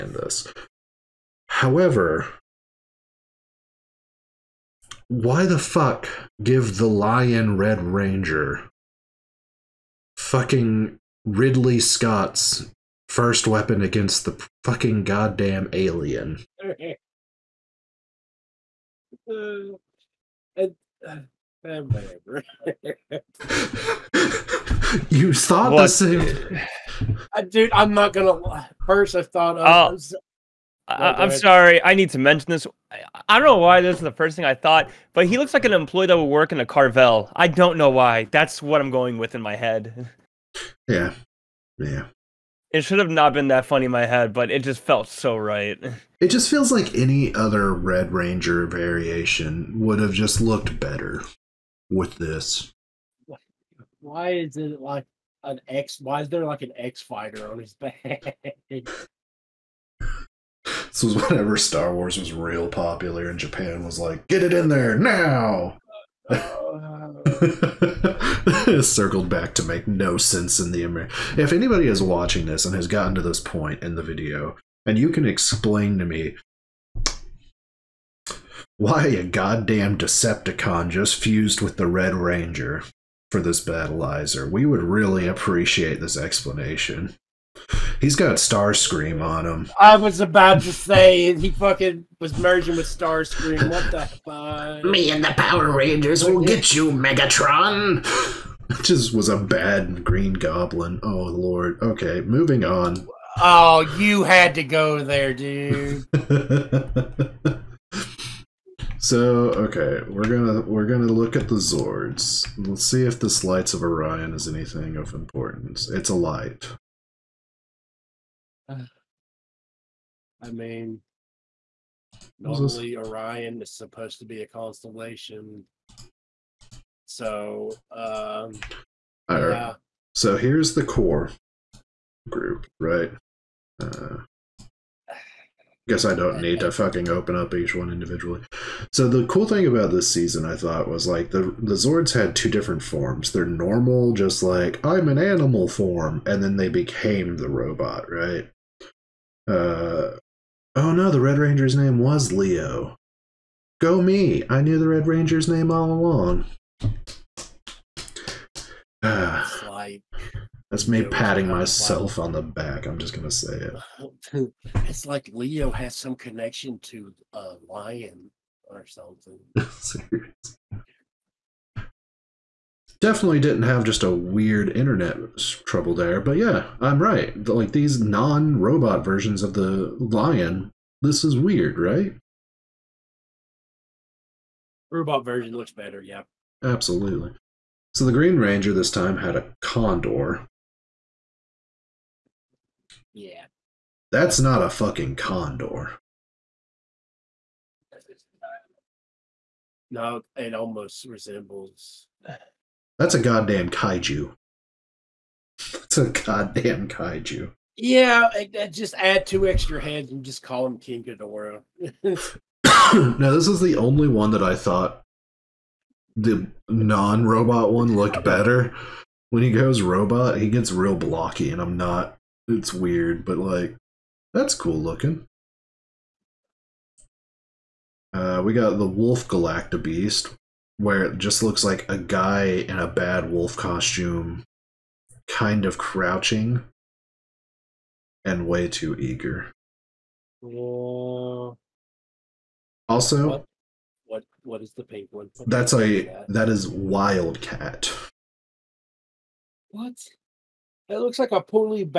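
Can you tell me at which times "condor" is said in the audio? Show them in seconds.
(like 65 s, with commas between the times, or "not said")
189 s, 195 s.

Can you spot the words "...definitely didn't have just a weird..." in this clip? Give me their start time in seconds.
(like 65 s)
173 s.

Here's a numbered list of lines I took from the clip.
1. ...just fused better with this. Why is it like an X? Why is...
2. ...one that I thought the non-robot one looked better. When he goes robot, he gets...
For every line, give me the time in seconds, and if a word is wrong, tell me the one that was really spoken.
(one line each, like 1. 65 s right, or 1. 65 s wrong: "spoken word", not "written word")
1. 50 s wrong: "looked", not "fused"
2. 214 s right.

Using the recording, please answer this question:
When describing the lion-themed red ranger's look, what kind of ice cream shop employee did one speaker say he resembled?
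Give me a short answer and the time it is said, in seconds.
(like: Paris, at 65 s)
Carvel, at 36 s.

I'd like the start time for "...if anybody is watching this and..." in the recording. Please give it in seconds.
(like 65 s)
71 s.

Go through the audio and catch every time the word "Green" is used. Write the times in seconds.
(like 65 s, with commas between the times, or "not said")
100 s, 188 s.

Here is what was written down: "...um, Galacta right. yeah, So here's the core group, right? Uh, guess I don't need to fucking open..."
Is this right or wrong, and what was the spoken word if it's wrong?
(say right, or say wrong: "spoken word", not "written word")
wrong: "All", not "Galacta".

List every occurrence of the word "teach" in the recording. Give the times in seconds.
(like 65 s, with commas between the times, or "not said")
not said.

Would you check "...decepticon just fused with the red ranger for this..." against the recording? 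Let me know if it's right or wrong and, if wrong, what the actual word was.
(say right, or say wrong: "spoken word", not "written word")
right.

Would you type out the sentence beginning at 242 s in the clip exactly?
Also, what, what, what is the pink one?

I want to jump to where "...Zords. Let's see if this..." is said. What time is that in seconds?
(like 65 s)
111 s.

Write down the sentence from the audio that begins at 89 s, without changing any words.
I was about to say he fucking was merging with Starscream.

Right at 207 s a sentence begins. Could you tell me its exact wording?
Yeah, just add two extra heads and just call him King Ghidorah.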